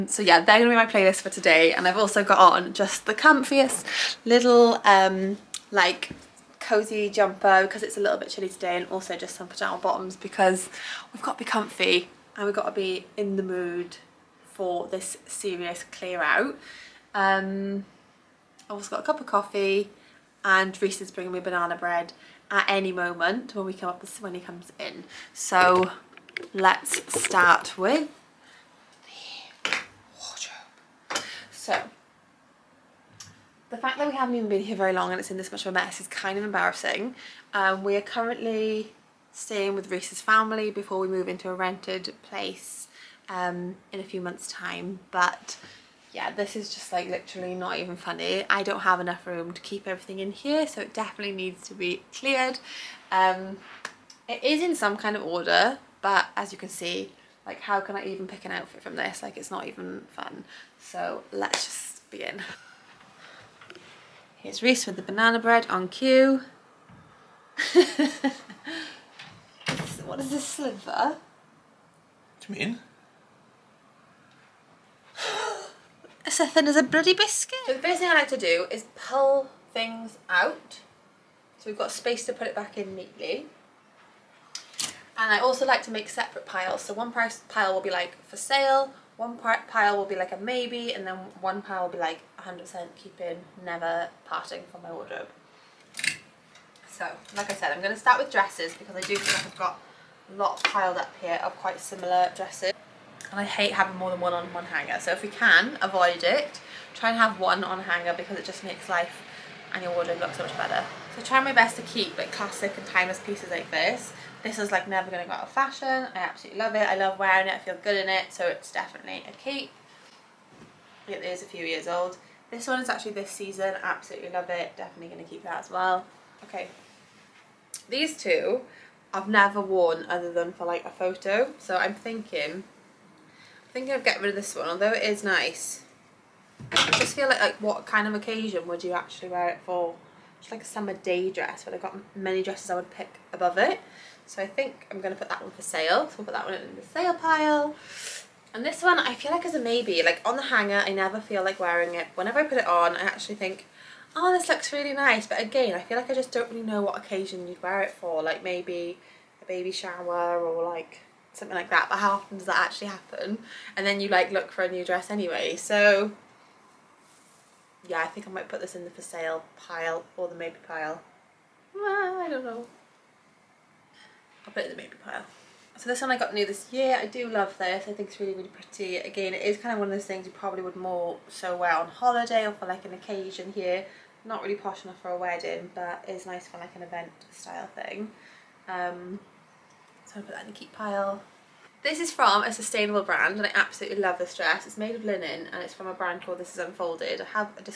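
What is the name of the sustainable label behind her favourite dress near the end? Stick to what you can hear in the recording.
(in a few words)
This Is Unfolded.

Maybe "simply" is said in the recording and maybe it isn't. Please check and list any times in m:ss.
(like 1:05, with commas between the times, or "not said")
not said.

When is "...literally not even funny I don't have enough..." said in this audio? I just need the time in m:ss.
0:47.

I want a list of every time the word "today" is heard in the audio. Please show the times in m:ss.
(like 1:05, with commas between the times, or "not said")
0:01, 0:08.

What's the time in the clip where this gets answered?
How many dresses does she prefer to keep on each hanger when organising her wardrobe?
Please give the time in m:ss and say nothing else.
1:47.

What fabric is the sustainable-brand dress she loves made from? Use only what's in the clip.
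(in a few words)
linen.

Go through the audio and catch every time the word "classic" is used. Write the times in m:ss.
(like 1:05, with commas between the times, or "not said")
1:52.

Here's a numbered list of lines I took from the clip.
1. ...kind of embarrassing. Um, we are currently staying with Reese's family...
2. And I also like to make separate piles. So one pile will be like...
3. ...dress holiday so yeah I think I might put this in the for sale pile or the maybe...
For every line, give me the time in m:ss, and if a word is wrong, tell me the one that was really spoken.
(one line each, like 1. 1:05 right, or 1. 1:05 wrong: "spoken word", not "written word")
1. 0:36 right
2. 1:25 right
3. 2:44 wrong: "anyway", not "holiday".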